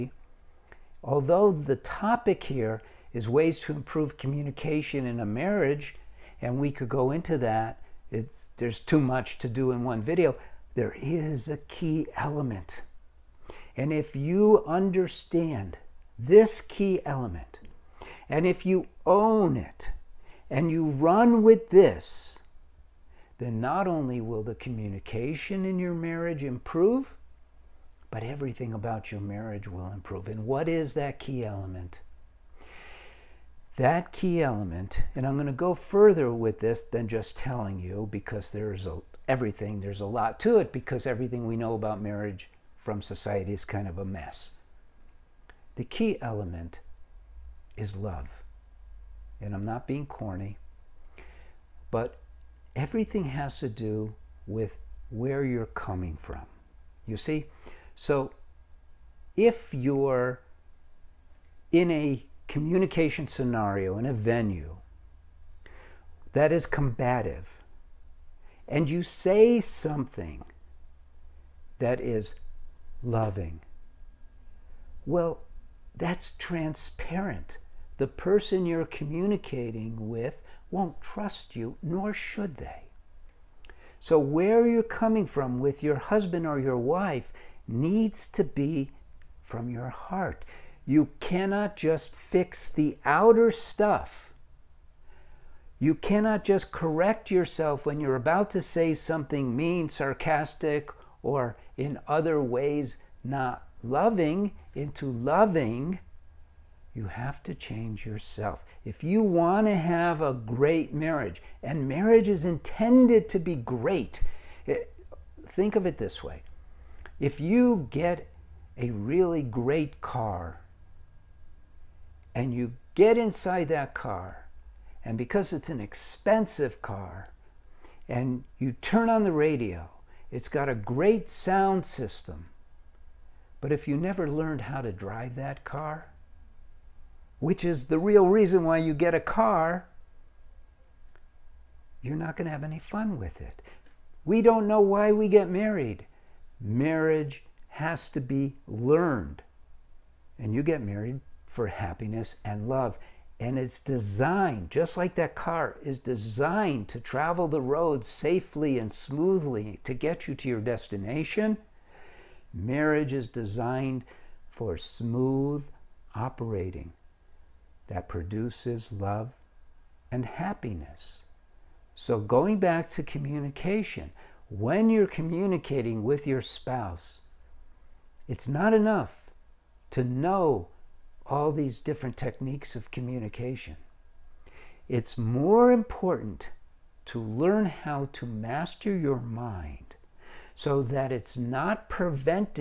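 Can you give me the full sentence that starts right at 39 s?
There's a lot to it because everything we know about marriage from society is kind of a mess.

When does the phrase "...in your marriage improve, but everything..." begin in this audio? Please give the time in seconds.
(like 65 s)
25 s.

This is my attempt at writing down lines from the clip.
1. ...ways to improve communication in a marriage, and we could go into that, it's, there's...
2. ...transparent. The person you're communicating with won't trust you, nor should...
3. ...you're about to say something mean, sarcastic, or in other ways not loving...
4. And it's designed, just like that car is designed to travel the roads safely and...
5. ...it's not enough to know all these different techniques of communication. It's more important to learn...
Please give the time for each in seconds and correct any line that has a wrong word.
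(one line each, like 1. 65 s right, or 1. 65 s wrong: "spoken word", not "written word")
1. 3 s right
2. 76 s right
3. 97 s right
4. 153 s right
5. 178 s right.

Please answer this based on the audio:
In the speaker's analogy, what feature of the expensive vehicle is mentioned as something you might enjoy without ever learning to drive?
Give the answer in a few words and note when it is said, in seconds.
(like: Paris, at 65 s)
Great sound system, at 130 s.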